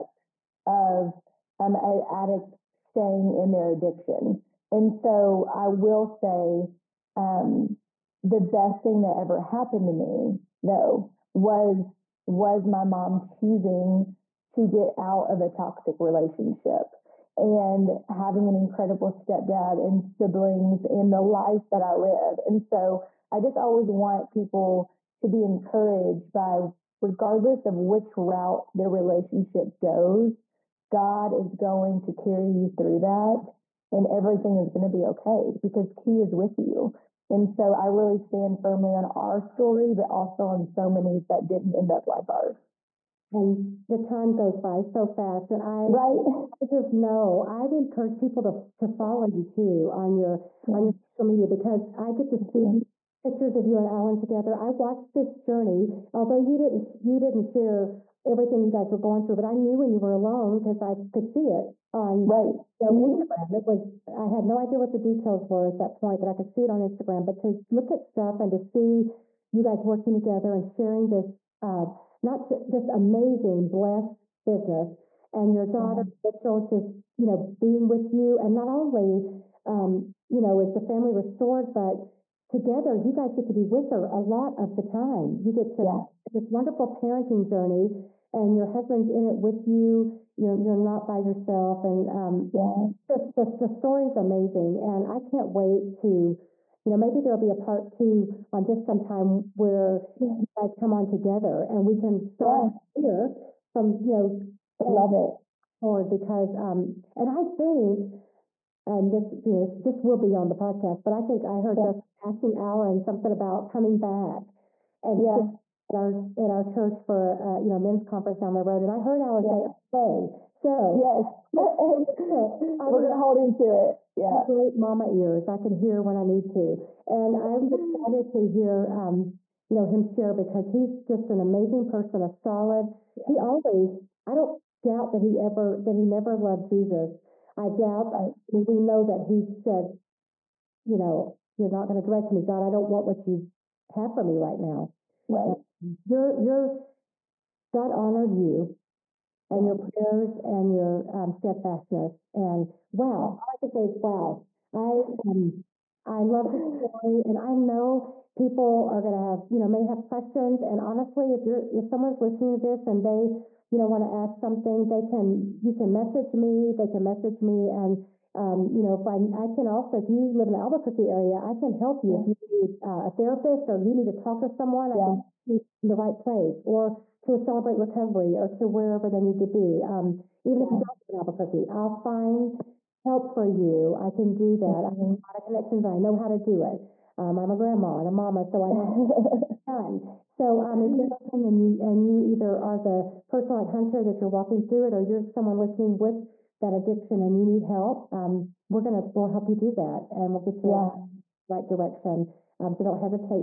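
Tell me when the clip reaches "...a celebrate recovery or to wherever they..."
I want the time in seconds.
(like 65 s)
177 s.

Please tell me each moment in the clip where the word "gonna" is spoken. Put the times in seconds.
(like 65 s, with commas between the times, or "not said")
122 s, 198 s.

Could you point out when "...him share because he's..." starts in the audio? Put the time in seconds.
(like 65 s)
129 s.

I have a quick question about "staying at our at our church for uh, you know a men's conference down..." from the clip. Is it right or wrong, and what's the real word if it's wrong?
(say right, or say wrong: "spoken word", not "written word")
wrong: "sharing", not "staying".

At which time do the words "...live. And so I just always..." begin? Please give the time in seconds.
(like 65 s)
21 s.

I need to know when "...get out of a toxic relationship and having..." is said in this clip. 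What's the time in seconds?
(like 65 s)
14 s.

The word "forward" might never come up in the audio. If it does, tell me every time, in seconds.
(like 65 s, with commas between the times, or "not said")
105 s.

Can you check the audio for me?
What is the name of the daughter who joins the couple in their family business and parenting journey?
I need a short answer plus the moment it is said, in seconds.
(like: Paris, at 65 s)
Mitchell, at 76 s.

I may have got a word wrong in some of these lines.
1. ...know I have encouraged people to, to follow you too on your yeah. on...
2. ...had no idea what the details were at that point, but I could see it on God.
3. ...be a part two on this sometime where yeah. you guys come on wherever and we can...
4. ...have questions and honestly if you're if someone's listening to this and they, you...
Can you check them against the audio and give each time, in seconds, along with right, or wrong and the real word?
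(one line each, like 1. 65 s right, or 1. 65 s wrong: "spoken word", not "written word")
1. 46 s right
2. 64 s wrong: "Instagram", not "God"
3. 97 s wrong: "together", not "wherever"
4. 159 s right.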